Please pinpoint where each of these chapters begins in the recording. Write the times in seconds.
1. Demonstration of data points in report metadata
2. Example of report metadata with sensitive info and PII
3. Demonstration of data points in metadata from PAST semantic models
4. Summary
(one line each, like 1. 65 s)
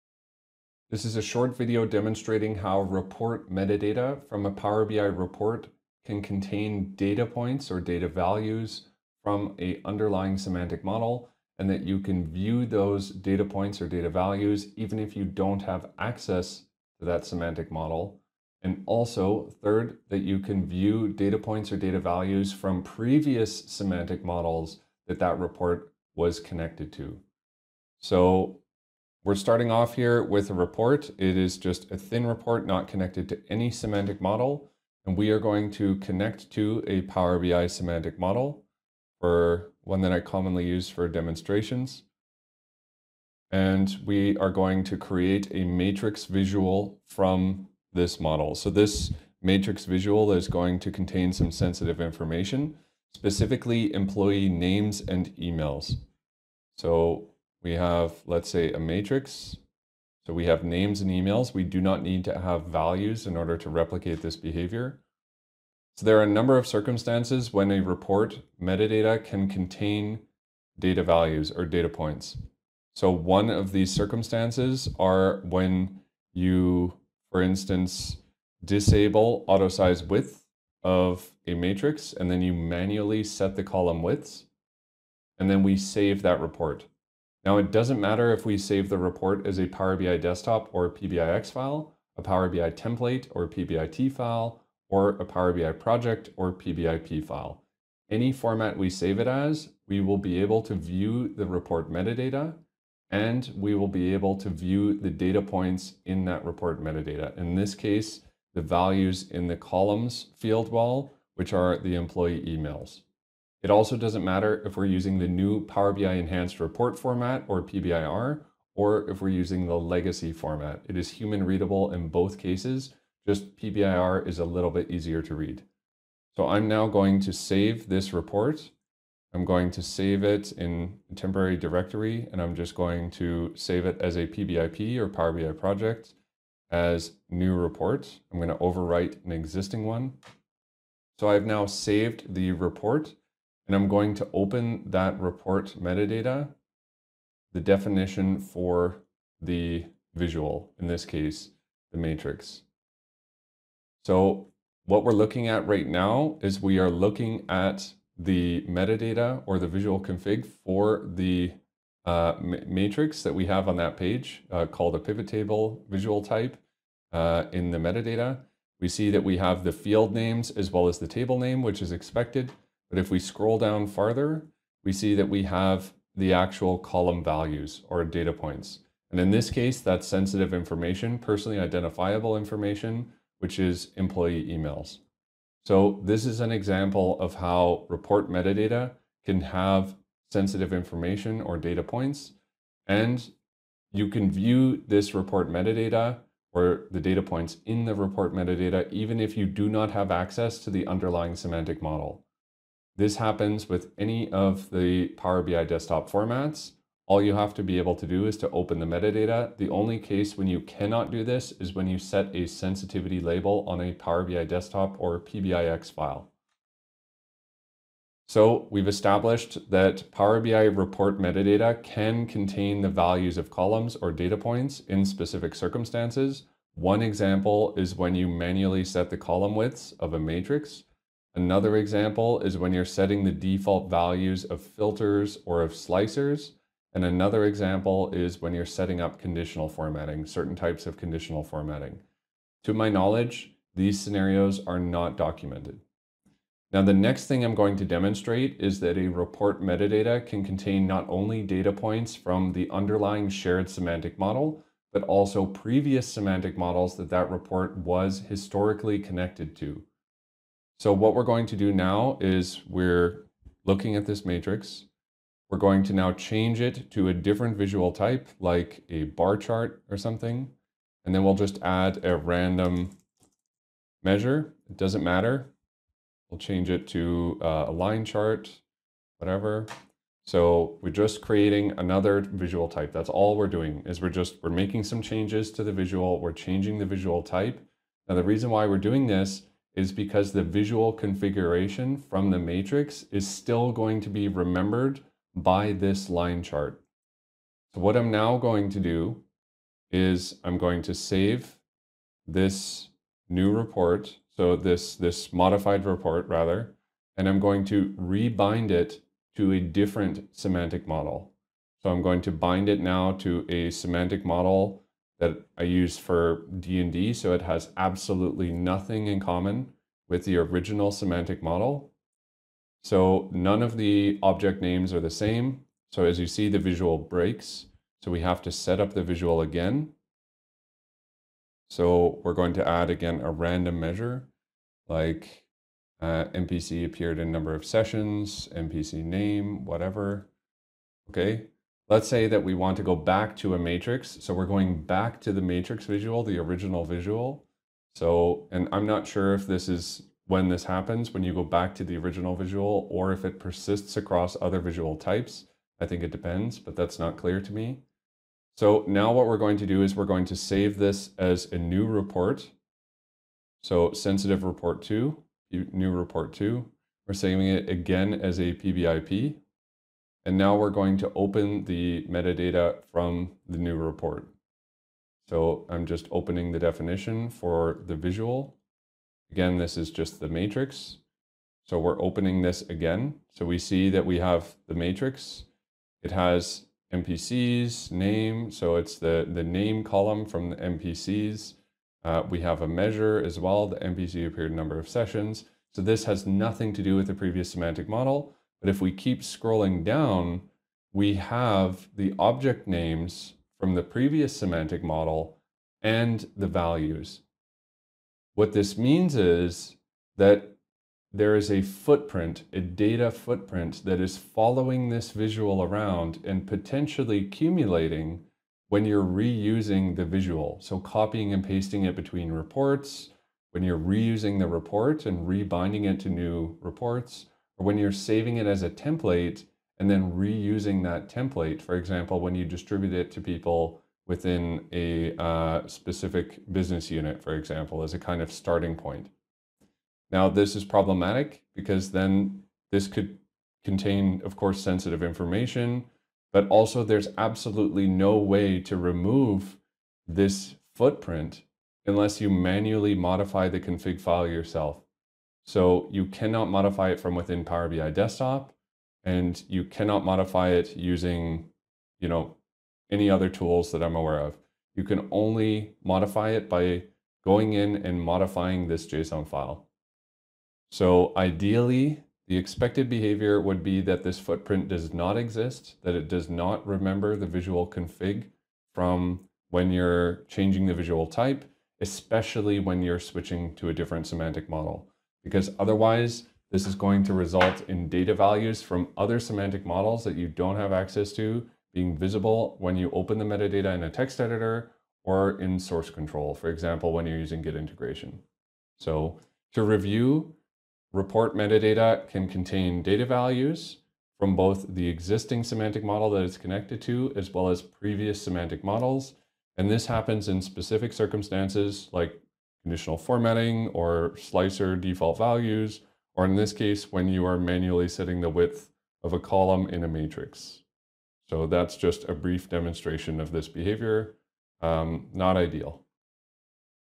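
1. 30 s
2. 154 s
3. 245 s
4. 500 s.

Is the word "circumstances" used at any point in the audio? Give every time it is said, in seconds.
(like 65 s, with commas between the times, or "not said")
66 s, 73 s, 225 s, 510 s.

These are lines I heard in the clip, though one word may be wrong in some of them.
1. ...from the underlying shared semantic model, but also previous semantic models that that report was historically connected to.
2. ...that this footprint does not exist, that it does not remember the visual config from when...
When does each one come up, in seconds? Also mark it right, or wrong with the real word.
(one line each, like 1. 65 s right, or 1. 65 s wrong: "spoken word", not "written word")
1. 252 s right
2. 473 s right.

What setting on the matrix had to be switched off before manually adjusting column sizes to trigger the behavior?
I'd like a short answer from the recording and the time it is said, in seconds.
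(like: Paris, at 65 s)
auto size width, at 79 s.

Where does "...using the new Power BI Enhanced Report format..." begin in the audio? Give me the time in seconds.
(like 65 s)
114 s.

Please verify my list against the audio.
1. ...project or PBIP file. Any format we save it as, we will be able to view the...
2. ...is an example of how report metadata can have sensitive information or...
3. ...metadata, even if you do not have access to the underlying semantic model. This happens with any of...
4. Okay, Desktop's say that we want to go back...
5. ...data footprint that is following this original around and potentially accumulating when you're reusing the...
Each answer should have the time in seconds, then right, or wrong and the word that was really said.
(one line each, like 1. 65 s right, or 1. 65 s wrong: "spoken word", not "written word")
1. 95 s right
2. 186 s right
3. 198 s right
4. 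341 s wrong: "Let", not "Desktop"
5. 412 s wrong: "visual", not "original".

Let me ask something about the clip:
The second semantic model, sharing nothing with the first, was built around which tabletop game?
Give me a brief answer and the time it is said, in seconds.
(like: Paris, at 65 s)
D&D, at 316 s.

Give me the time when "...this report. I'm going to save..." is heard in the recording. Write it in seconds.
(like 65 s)
127 s.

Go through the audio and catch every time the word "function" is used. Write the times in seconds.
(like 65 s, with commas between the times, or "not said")
not said.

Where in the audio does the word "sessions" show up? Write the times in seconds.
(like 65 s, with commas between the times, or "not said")
337 s, 394 s.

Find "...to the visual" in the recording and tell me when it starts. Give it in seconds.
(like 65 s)
285 s.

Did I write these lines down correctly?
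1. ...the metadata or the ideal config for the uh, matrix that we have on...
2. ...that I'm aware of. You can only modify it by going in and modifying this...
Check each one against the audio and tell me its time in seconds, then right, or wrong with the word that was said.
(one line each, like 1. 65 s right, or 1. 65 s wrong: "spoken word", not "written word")
1. 158 s wrong: "visual", not "ideal"
2. 463 s right.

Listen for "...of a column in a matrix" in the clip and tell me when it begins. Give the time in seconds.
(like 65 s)
519 s.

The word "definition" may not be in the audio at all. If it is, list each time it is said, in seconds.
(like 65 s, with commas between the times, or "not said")
147 s, 376 s.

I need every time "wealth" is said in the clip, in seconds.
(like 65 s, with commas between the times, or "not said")
not said.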